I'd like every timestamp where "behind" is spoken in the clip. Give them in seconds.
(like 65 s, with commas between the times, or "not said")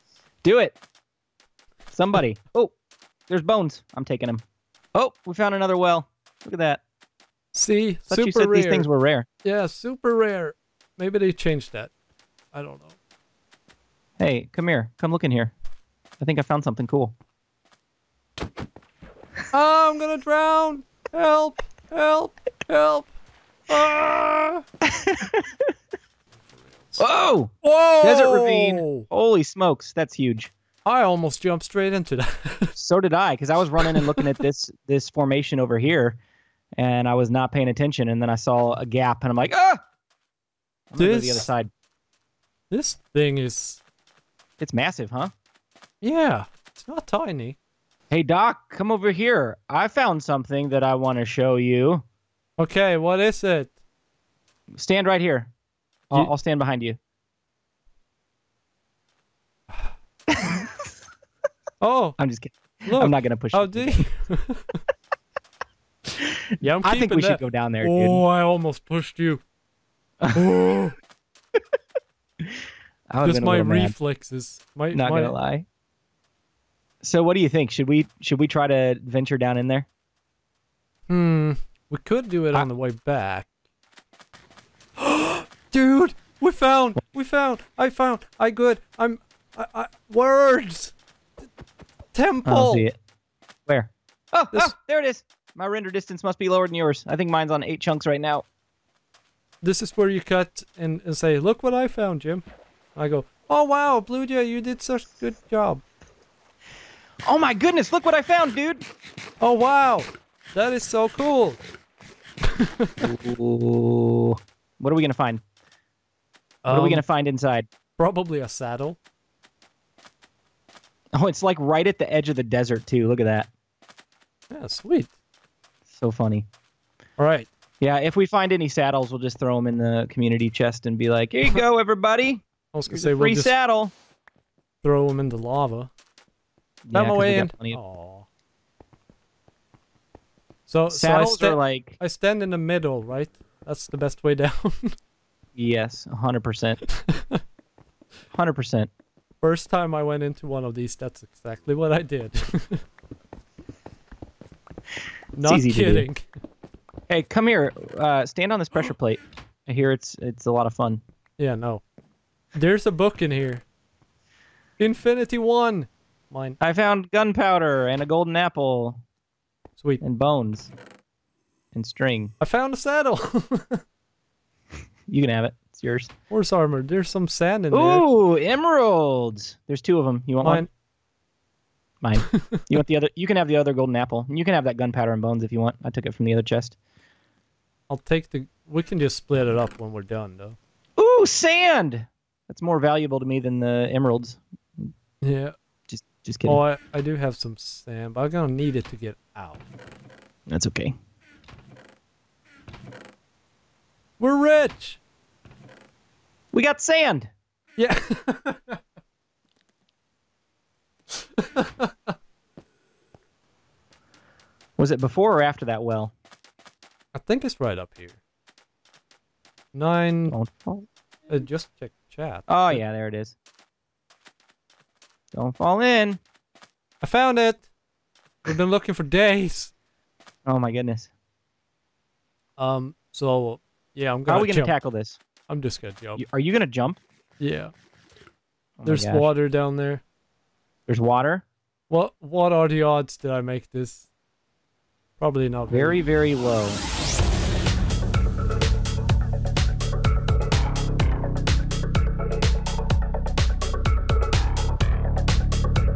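56 s.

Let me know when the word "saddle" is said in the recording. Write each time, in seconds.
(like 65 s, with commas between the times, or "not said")
118 s, 128 s, 133 s, 140 s, 172 s.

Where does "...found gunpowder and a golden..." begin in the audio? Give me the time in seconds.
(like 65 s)
166 s.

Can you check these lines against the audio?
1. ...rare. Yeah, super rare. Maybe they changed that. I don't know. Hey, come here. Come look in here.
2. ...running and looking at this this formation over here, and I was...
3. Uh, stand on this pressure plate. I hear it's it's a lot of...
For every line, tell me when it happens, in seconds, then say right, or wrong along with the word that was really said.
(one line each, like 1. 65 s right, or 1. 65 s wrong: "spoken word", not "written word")
1. 8 s right
2. 33 s right
3. 157 s right.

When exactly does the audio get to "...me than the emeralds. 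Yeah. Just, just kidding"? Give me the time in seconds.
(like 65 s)
193 s.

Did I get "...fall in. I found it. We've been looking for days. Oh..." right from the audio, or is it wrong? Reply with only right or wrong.
right.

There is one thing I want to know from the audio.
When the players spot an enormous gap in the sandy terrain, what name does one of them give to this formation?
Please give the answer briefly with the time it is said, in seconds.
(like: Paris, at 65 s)
Desert ravine, at 28 s.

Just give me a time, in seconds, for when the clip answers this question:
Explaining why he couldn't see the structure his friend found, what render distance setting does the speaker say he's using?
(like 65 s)
97 s.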